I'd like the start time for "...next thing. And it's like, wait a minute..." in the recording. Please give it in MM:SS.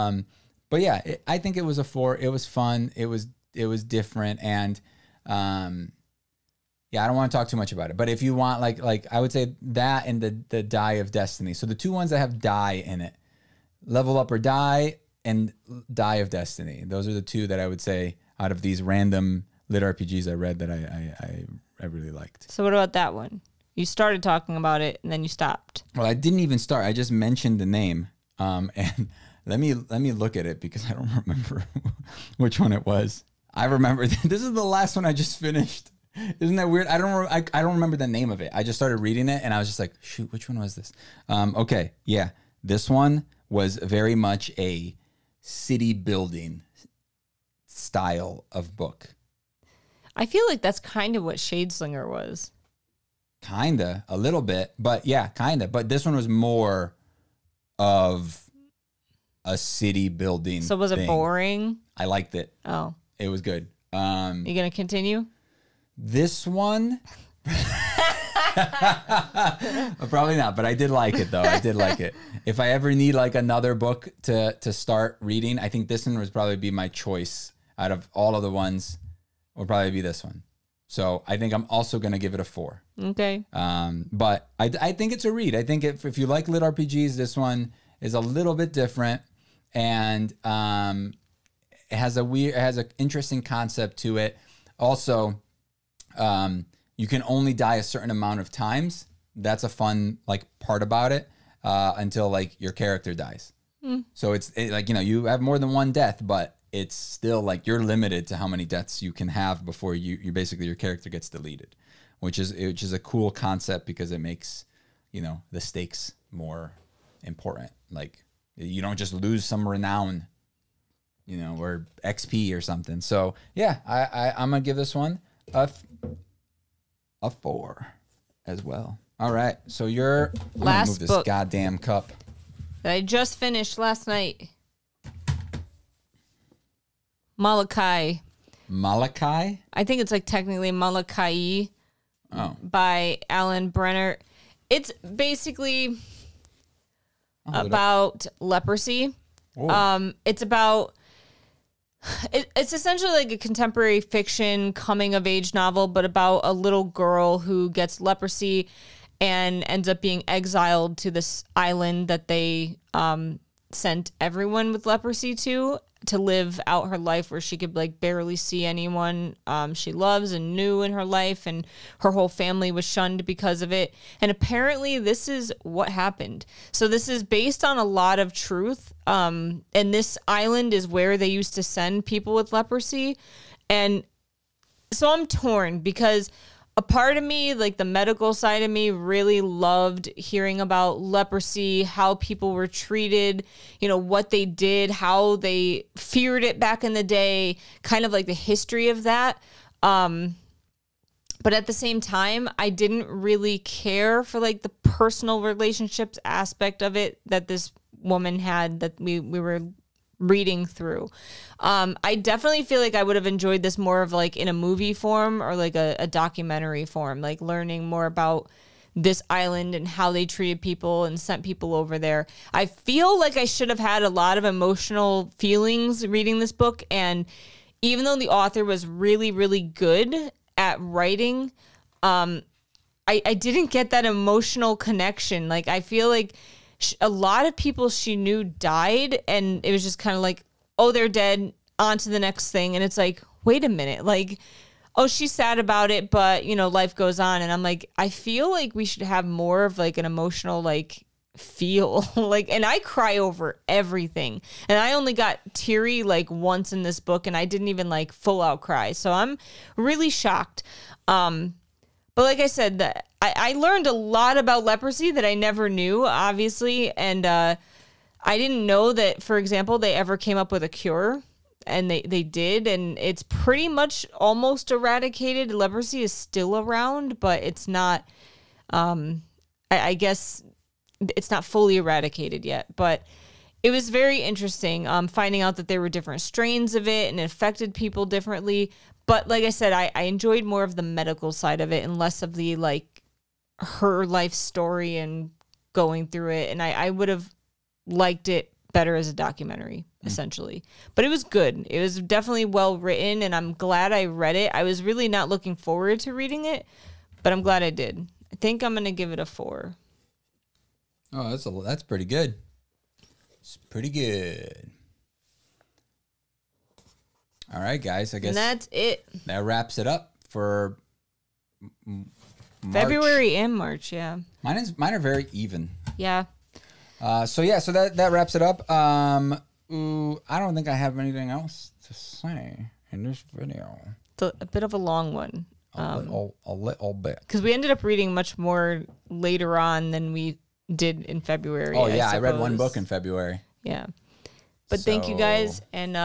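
04:02.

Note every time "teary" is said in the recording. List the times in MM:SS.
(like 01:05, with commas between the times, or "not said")
04:15.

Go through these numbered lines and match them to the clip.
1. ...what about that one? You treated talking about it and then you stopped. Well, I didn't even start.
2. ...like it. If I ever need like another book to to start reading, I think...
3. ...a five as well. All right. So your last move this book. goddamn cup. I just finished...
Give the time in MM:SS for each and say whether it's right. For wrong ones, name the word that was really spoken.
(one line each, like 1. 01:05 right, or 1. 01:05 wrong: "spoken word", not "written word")
1. 00:22 wrong: "started", not "treated"
2. 01:11 right
3. 02:07 wrong: "four", not "five".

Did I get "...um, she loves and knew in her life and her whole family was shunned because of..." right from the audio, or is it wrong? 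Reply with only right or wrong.
right.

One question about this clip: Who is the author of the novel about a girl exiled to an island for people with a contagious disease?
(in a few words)
Alan Brennert.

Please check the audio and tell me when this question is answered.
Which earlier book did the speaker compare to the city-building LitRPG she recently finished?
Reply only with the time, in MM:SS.
00:51.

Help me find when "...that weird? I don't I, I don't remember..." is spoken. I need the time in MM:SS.
00:36.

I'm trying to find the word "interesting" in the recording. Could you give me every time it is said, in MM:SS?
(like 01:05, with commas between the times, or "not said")
01:32, 04:44.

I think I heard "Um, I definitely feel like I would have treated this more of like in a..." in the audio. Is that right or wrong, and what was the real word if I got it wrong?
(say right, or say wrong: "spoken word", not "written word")
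wrong: "enjoyed", not "treated".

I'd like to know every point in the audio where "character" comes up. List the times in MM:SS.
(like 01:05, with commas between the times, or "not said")
01:42, 01:50.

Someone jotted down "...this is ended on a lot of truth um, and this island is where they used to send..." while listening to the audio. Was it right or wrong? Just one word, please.
wrong.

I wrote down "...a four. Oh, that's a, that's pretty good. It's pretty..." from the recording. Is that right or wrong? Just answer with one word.
right.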